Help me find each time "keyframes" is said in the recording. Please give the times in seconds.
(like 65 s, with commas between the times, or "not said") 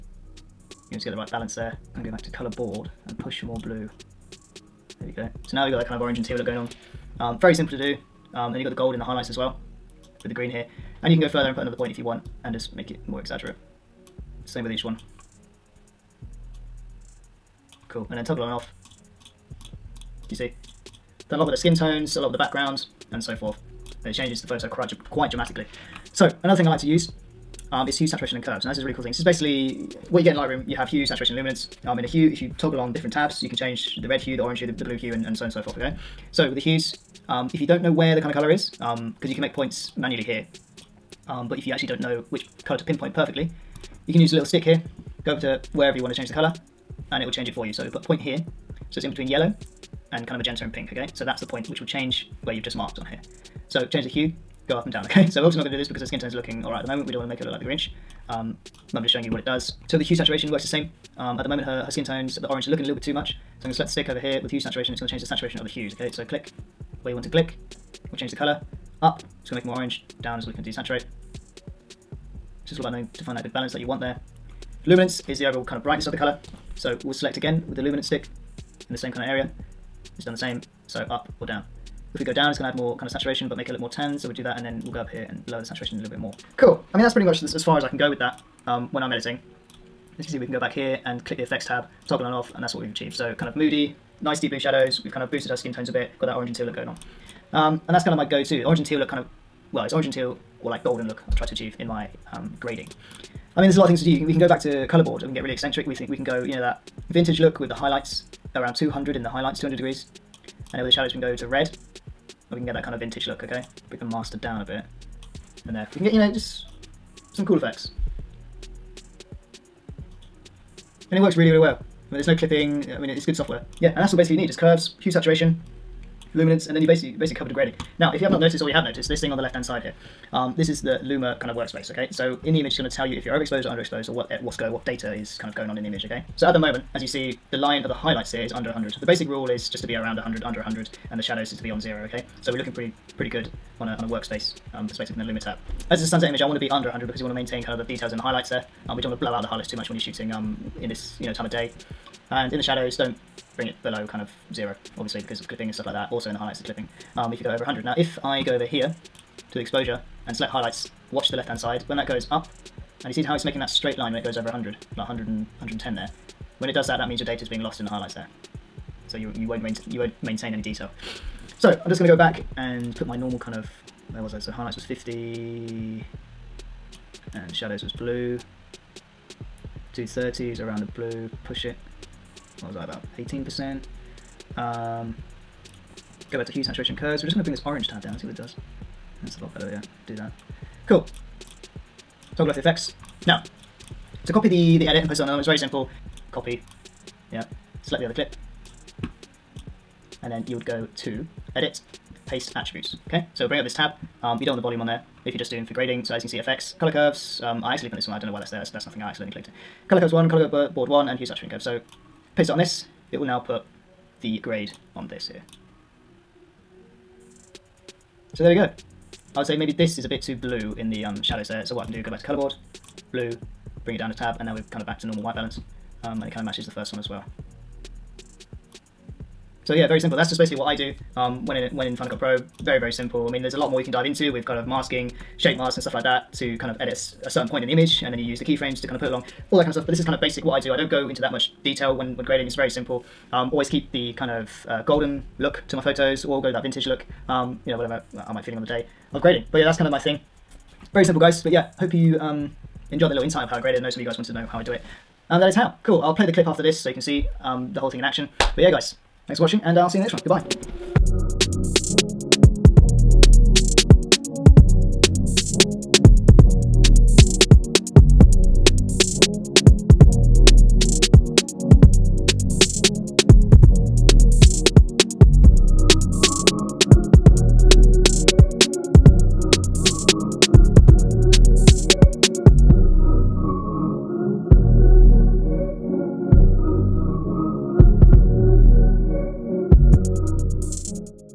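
238 s.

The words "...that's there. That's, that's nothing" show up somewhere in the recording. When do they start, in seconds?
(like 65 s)
208 s.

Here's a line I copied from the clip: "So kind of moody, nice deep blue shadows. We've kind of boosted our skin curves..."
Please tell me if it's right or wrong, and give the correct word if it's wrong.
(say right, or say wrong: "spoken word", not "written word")
wrong: "tones", not "curves".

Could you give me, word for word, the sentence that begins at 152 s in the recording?
And in the shadows, don't bring it below kind of zero, obviously, because of clipping and stuff like that.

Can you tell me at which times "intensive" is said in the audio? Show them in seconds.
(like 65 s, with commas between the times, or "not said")
not said.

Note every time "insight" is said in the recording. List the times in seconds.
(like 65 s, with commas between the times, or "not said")
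253 s.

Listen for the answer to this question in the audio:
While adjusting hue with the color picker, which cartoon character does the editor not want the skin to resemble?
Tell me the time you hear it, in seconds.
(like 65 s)
57 s.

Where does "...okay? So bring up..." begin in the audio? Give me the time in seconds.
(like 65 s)
203 s.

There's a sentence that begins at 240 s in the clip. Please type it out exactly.
I don't go into that much detail when when grading.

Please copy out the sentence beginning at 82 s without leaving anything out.
If we go down, it's going to add more kind of saturation, but make it look more tan.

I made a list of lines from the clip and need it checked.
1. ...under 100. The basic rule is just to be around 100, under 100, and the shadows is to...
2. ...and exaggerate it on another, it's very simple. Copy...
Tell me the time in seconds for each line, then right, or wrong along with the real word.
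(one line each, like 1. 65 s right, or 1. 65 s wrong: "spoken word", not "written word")
1. 138 s right
2. 195 s wrong: "paste", not "exaggerate".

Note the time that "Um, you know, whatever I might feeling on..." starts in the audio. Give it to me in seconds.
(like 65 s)
247 s.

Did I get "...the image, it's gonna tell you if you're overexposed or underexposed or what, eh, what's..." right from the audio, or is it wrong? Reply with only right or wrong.
right.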